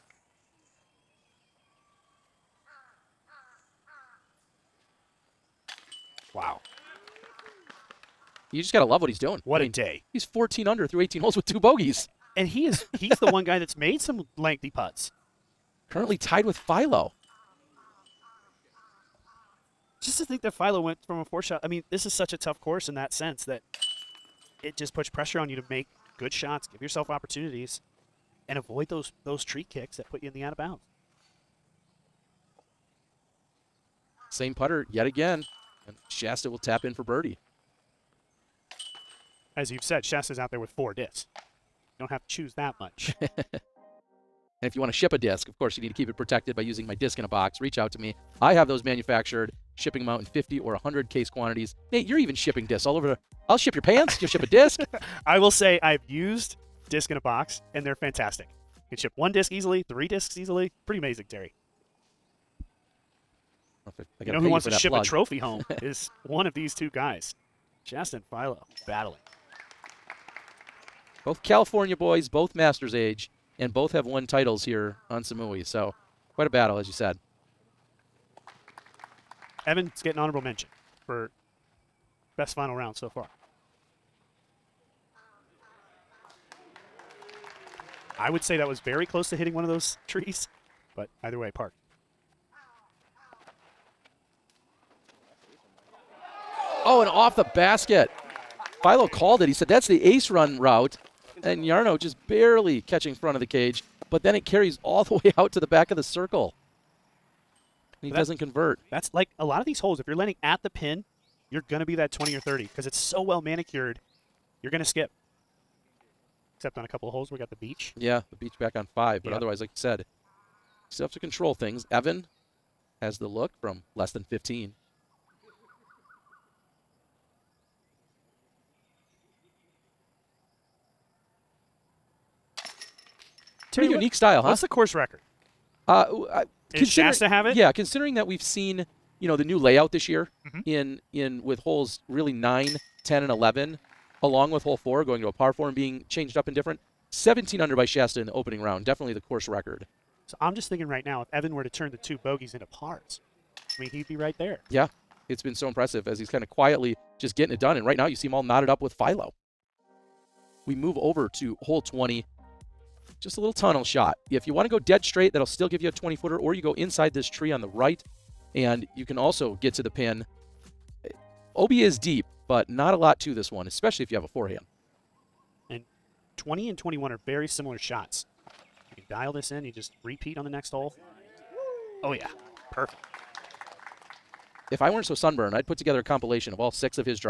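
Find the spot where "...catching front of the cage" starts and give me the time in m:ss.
1:42.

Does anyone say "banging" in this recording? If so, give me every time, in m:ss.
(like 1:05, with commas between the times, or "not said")
not said.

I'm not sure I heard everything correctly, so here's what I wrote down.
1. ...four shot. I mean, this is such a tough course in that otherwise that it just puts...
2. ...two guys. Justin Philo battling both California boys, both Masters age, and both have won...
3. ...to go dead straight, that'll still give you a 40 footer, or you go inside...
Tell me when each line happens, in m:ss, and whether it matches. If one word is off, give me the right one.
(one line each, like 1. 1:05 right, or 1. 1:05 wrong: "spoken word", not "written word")
1. 0:21 wrong: "sense", not "otherwise"
2. 1:06 right
3. 2:44 wrong: "20", not "40".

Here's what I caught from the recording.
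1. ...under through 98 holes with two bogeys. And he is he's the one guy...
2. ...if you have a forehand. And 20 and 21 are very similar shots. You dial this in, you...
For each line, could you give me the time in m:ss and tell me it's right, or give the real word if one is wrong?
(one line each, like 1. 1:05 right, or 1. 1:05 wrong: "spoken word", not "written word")
1. 0:10 wrong: "18", not "98"
2. 2:54 right.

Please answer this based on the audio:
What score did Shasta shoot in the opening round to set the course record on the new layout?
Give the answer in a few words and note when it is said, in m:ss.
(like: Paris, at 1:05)
17 under, at 2:27.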